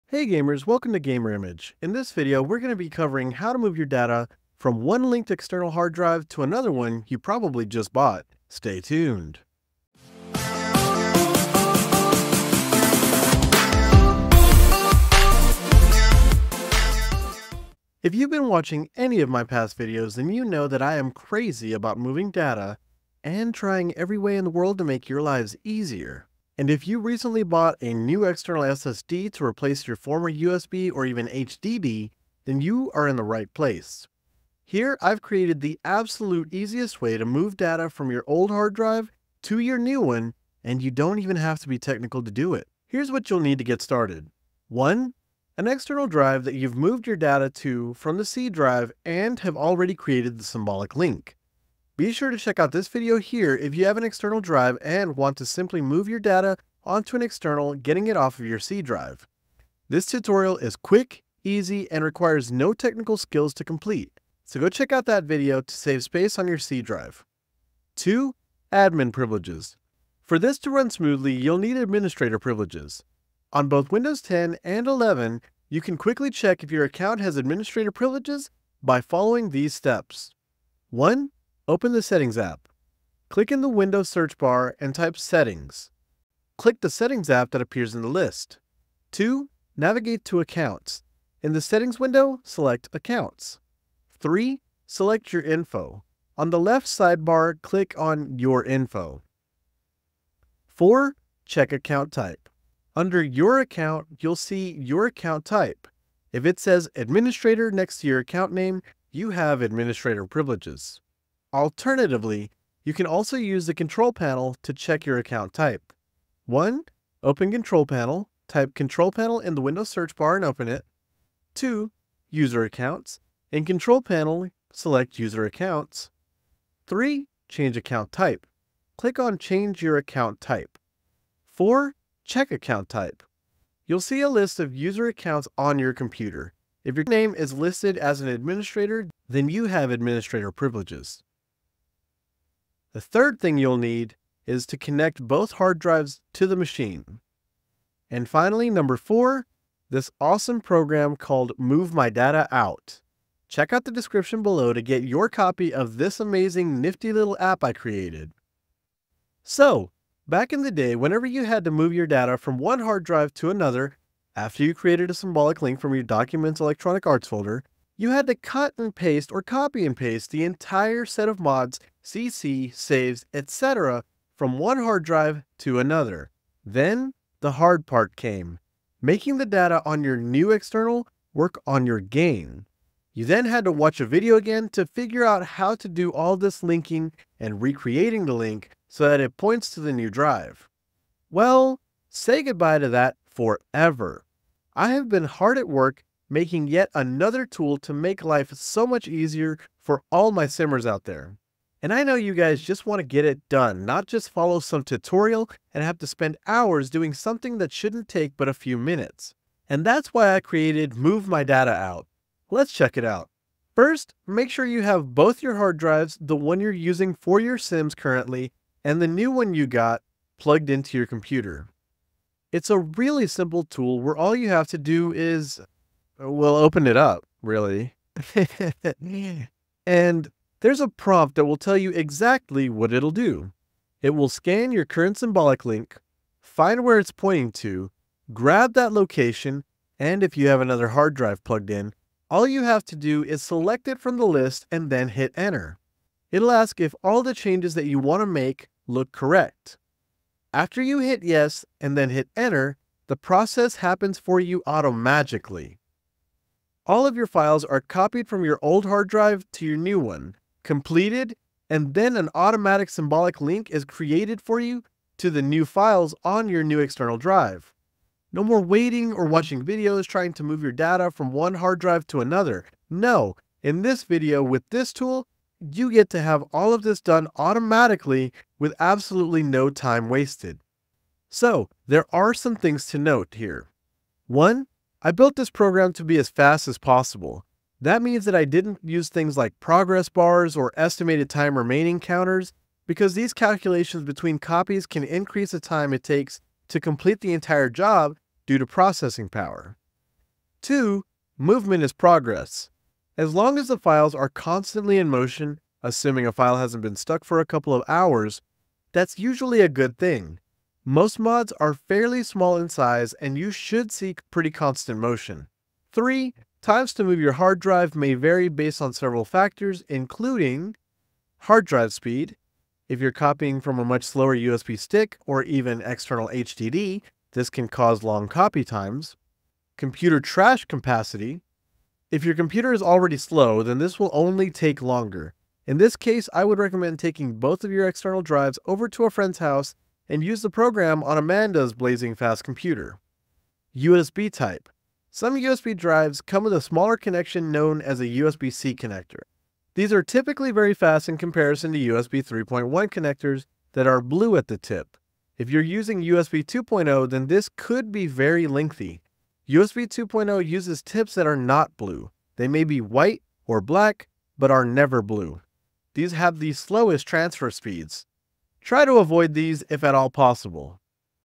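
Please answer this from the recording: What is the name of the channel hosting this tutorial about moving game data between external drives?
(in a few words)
Gamer Image.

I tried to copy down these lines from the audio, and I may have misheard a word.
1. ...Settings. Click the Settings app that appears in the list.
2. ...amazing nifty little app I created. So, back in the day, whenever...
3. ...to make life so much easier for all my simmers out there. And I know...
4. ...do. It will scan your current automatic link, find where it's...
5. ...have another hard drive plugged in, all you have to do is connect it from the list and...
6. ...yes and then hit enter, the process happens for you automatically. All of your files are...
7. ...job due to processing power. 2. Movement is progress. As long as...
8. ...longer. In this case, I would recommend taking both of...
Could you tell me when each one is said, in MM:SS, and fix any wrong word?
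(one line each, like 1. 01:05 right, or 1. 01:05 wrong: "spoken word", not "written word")
1. 01:25 right
2. 02:36 right
3. 03:17 right
4. 03:53 wrong: "symbolic", not "automatic"
5. 04:00 wrong: "select", not "connect"
6. 04:11 right
7. 04:57 right
8. 05:34 right.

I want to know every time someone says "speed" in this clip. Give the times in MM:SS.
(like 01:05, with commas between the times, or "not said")
05:21, 06:07.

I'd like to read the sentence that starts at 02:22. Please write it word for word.
The third thing you'll need is to connect both hard drives to the machine.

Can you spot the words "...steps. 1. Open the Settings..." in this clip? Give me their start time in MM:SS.
01:19.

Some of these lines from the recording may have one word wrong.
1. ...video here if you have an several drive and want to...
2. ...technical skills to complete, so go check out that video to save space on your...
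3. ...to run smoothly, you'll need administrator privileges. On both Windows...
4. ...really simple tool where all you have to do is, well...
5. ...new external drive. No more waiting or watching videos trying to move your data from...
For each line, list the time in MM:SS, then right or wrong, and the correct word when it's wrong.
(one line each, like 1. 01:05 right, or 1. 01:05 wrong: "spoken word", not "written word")
1. 00:52 wrong: "external", not "several"
2. 01:02 right
3. 01:10 right
4. 03:42 right
5. 04:26 right.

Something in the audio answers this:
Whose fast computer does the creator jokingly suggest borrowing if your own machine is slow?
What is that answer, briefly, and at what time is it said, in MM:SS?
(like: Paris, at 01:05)
Amanda, at 05:41.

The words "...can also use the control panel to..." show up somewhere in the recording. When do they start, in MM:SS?
01:52.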